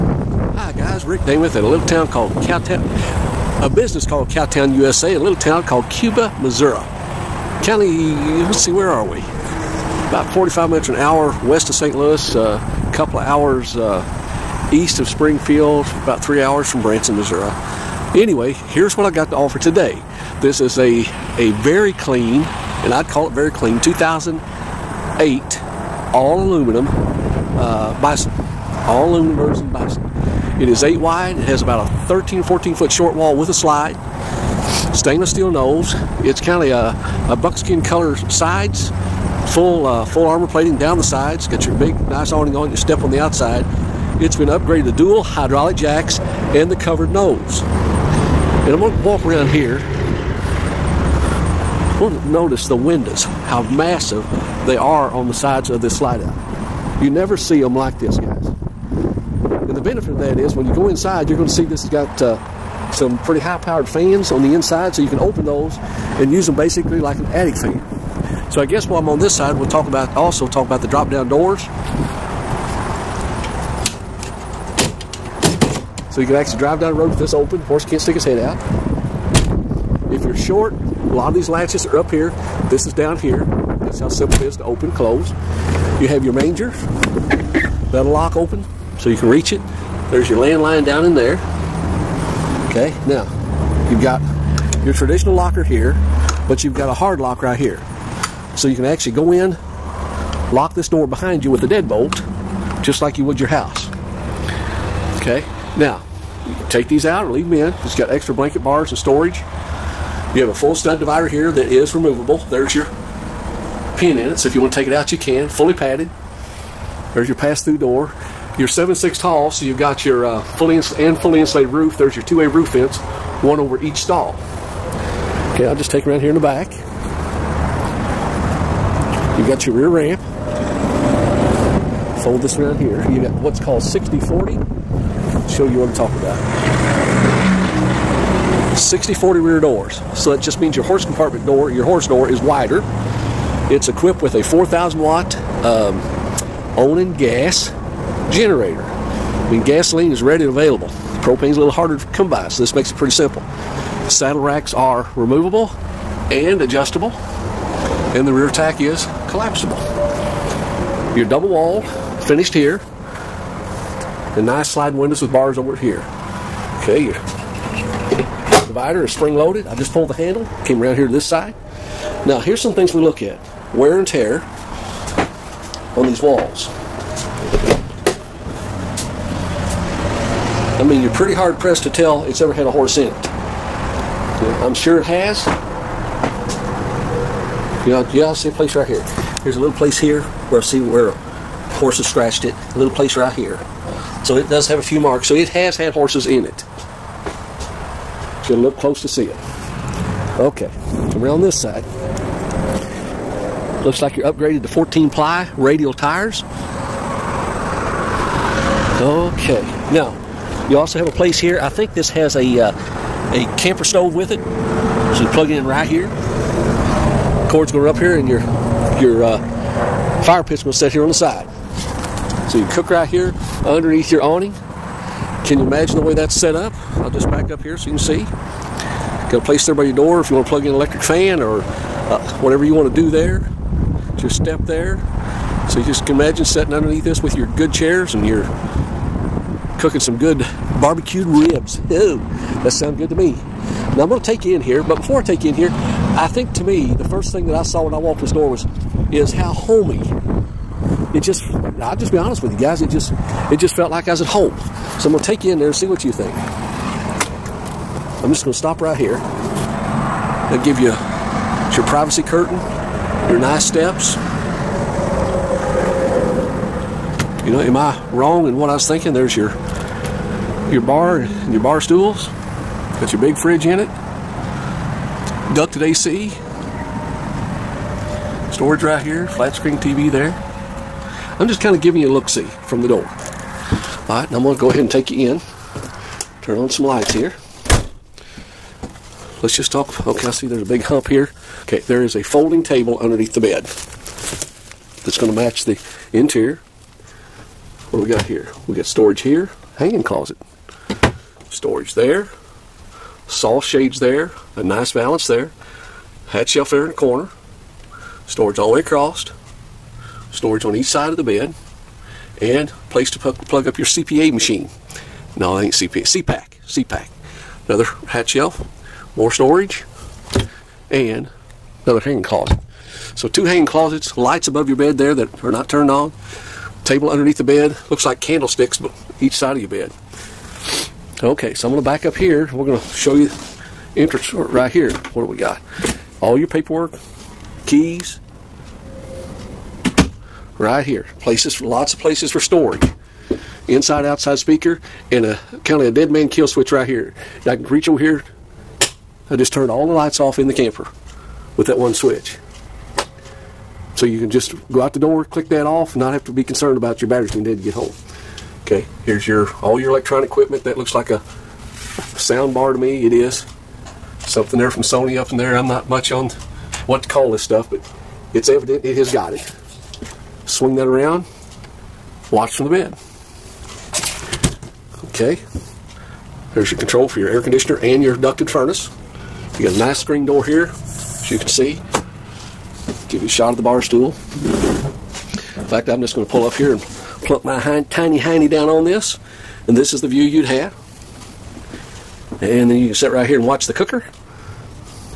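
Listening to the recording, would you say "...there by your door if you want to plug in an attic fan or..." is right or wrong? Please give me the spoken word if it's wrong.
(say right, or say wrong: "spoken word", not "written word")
wrong: "electric", not "attic".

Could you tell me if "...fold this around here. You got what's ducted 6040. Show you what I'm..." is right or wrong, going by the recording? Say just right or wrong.
wrong.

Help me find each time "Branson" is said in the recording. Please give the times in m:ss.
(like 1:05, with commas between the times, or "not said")
0:16.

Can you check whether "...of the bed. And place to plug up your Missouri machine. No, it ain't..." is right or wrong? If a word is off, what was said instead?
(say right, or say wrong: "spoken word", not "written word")
wrong: "CPA", not "Missouri".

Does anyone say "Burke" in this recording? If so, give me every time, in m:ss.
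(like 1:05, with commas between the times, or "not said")
not said.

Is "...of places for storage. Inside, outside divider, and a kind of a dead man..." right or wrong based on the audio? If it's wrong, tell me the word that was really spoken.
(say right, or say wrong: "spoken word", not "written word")
wrong: "speaker", not "divider".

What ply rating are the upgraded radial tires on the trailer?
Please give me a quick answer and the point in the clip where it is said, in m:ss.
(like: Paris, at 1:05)
14 ply, at 3:24.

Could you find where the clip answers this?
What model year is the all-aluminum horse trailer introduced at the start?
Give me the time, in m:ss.
0:23.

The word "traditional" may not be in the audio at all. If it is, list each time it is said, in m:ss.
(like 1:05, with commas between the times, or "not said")
1:34.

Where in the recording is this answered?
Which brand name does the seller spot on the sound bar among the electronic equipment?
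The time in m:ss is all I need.
6:04.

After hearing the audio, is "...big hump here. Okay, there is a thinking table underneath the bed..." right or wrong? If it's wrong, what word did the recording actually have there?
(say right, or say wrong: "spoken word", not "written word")
wrong: "folding", not "thinking".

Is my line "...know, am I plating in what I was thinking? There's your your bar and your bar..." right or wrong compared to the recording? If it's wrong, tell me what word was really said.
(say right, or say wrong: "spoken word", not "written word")
wrong: "wrong", not "plating".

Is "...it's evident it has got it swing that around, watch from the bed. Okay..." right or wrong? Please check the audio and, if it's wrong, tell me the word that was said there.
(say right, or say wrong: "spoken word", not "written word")
right.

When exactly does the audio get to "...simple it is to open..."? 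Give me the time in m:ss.
1:24.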